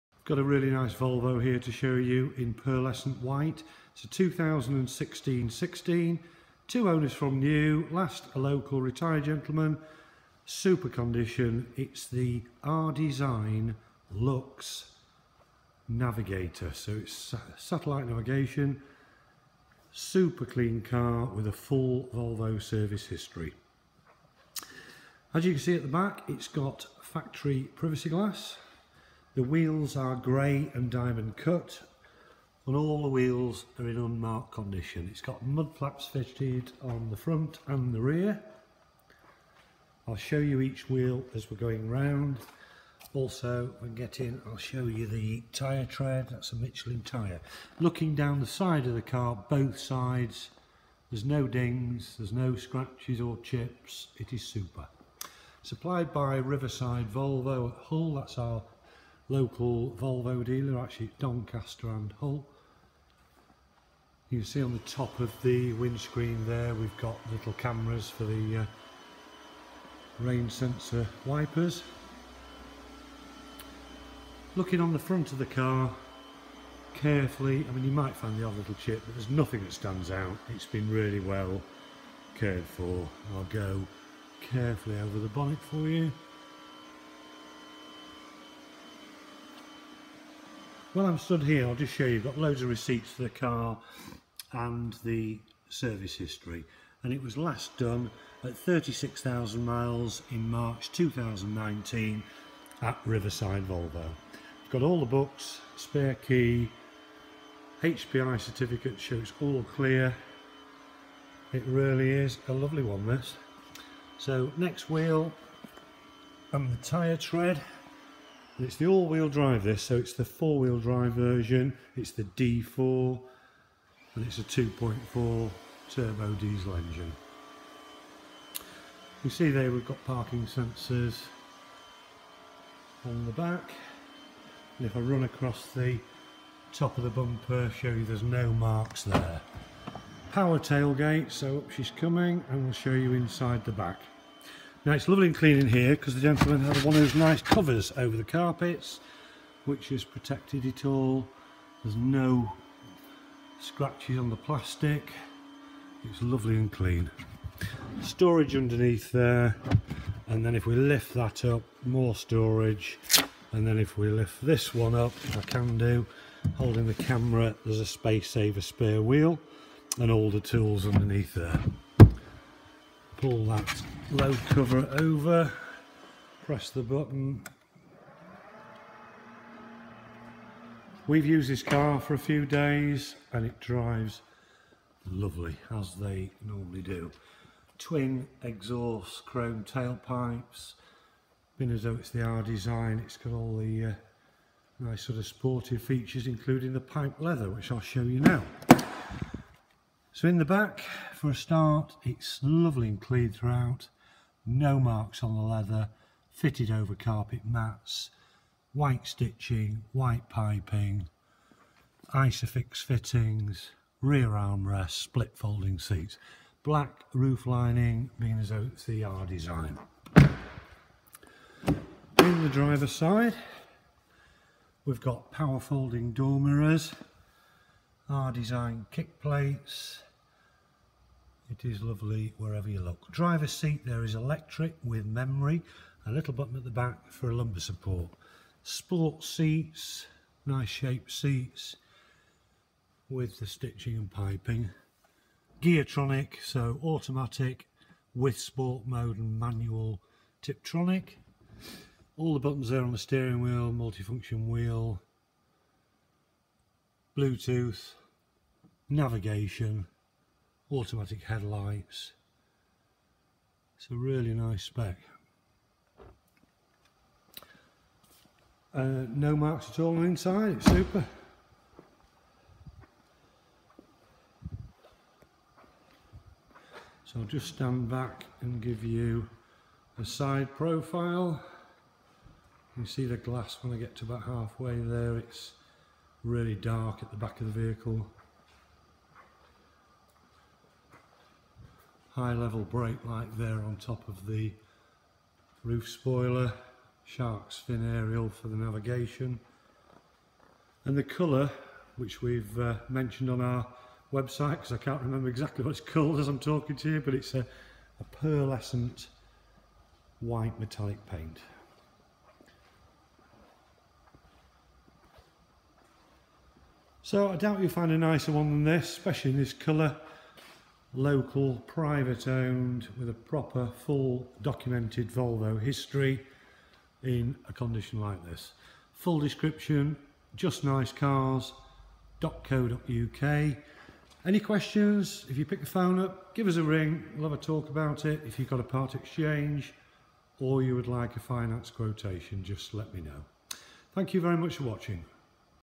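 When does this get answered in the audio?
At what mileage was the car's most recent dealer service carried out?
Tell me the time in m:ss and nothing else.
1:38.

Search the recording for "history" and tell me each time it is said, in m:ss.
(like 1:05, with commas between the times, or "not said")
0:23, 1:36, 5:25.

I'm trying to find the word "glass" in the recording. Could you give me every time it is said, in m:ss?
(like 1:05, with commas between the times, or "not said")
0:28, 4:43.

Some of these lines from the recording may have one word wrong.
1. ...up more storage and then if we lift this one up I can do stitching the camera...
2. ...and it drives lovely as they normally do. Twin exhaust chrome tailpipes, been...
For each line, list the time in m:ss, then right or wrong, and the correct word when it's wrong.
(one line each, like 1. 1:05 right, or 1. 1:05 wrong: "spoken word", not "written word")
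1. 2:41 wrong: "holding", not "stitching"
2. 3:03 right.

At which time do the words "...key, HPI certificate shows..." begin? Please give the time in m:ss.
1:46.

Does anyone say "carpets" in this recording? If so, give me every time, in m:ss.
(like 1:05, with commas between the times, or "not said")
2:28, 3:26.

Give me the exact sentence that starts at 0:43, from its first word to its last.
Also, when getting, I'll show you the tyre tread.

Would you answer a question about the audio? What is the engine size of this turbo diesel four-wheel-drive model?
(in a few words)
2.4.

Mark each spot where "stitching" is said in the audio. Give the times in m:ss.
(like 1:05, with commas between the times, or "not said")
3:29, 4:03.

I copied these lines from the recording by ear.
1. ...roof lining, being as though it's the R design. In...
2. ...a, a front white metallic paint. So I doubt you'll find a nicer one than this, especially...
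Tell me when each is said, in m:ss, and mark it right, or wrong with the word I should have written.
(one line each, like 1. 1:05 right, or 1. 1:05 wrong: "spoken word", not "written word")
1. 3:37 right
2. 5:07 wrong: "pearlescent", not "front".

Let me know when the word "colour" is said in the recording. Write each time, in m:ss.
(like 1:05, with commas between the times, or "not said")
5:01, 5:19.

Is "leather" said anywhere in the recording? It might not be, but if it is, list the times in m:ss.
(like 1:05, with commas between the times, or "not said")
3:17, 3:25.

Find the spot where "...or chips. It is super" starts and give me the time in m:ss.
0:53.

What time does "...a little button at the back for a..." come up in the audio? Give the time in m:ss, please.
3:56.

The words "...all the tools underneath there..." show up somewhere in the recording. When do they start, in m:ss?
2:50.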